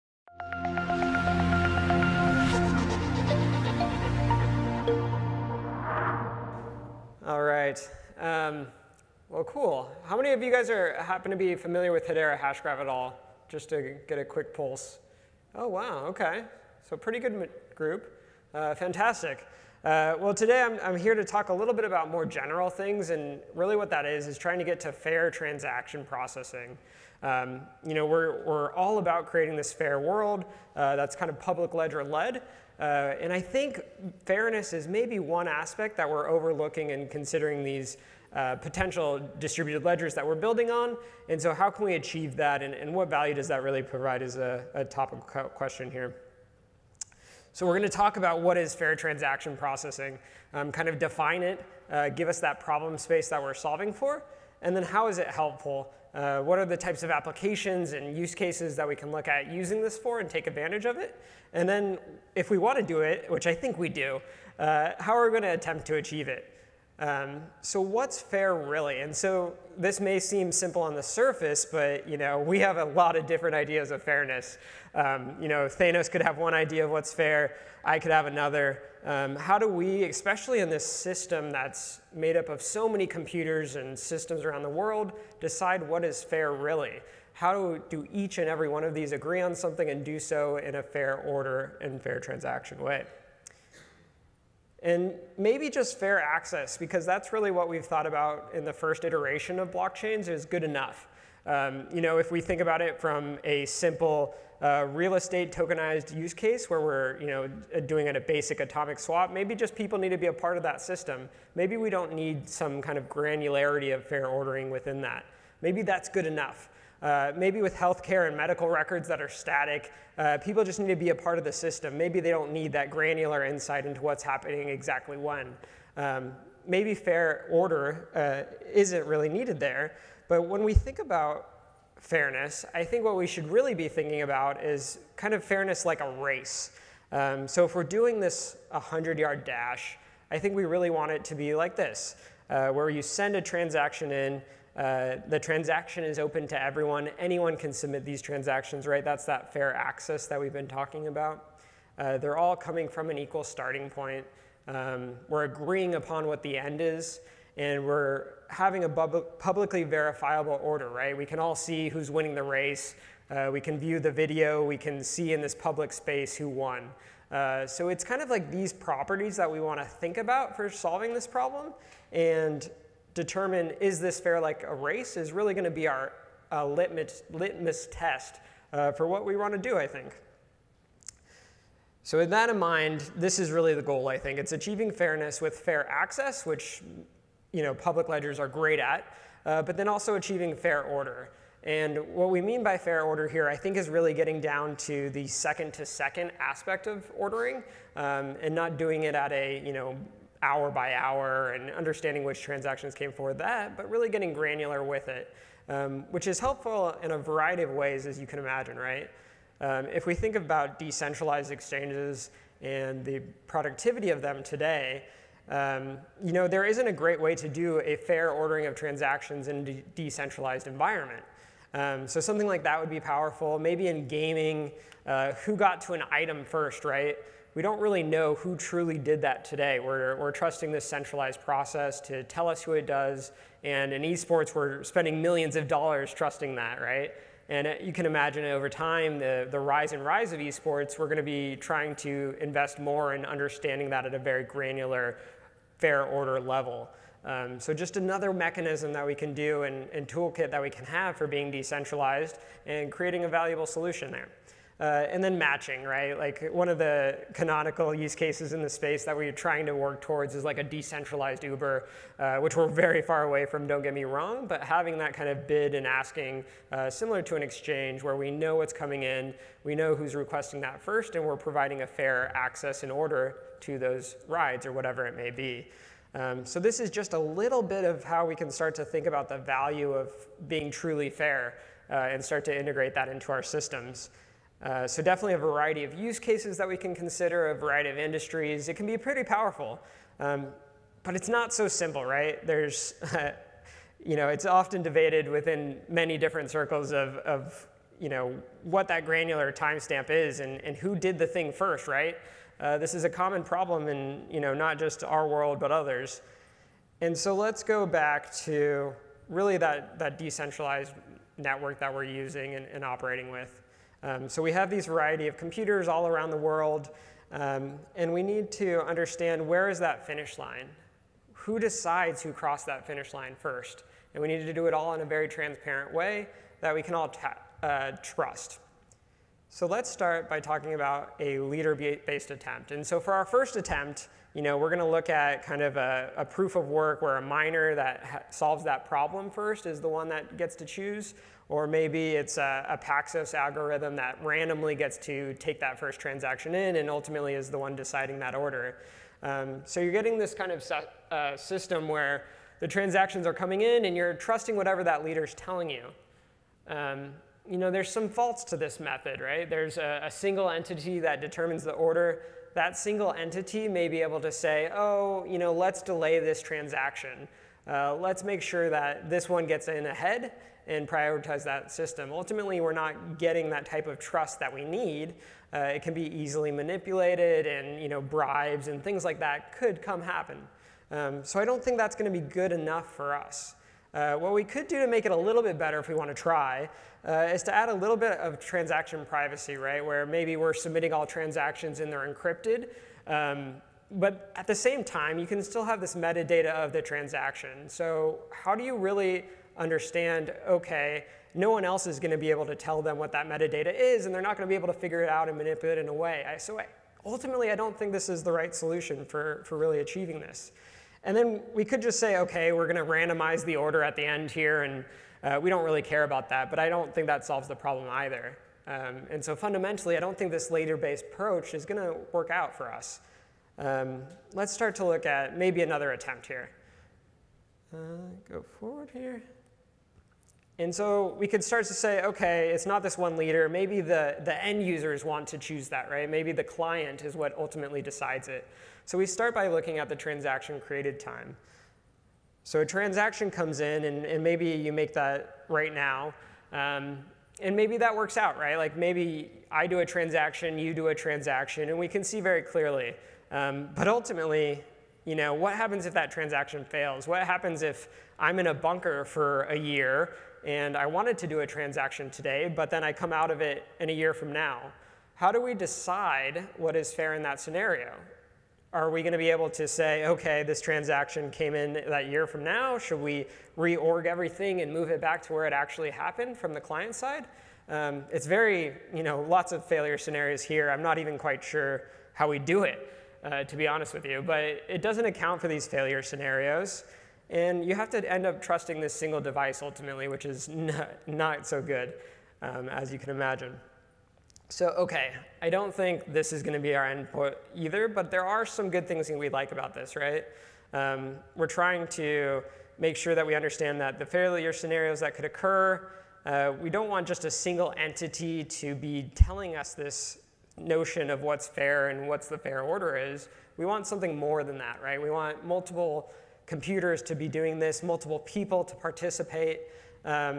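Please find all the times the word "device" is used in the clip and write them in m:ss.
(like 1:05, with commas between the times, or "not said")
8:09.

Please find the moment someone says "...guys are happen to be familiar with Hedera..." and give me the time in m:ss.
0:10.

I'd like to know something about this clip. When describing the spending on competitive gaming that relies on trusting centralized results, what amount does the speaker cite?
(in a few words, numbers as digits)
millions of dollars.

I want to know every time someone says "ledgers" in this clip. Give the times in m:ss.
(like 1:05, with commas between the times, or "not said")
0:31, 0:39, 3:08.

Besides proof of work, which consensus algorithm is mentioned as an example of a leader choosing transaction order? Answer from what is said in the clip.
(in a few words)
Paxos.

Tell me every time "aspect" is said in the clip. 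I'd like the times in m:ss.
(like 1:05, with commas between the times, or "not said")
0:35, 3:16.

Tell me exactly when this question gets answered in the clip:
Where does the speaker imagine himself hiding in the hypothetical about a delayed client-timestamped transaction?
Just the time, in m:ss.
7:38.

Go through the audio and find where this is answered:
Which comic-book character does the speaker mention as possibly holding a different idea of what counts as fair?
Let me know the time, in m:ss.
1:15.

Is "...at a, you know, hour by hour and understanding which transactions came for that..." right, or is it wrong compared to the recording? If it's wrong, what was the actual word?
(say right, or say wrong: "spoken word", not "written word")
right.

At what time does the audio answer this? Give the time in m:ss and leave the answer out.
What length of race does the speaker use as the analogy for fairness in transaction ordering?
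2:18.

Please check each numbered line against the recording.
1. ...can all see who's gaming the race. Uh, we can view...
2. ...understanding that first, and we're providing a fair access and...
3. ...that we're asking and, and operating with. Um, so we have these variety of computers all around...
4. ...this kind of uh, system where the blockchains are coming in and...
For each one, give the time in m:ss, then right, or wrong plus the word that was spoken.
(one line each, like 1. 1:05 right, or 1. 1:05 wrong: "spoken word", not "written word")
1. 2:41 wrong: "winning", not "gaming"
2. 4:30 wrong: "requesting", not "understanding"
3. 5:11 wrong: "using", not "asking"
4. 5:50 wrong: "transactions", not "blockchains".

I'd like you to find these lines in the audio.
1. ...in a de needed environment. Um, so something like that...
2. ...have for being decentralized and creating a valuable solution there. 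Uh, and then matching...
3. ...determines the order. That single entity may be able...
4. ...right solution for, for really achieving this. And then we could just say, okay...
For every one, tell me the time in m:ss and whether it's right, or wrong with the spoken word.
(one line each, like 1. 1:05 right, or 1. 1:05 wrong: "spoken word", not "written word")
1. 3:39 wrong: "decentralized", not "needed"
2. 4:10 right
3. 6:01 right
4. 6:48 right.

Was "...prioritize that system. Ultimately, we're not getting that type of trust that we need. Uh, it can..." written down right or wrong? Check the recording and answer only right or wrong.
right.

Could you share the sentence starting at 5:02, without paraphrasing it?
Uh, this is a common problem in, you know, not just our world, but others.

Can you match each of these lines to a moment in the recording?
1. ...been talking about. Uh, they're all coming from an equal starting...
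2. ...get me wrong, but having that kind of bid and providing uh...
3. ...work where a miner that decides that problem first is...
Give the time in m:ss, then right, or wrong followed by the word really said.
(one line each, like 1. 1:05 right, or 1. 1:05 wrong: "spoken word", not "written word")
1. 2:30 right
2. 4:23 wrong: "asking", not "providing"
3. 5:36 wrong: "solves", not "decides".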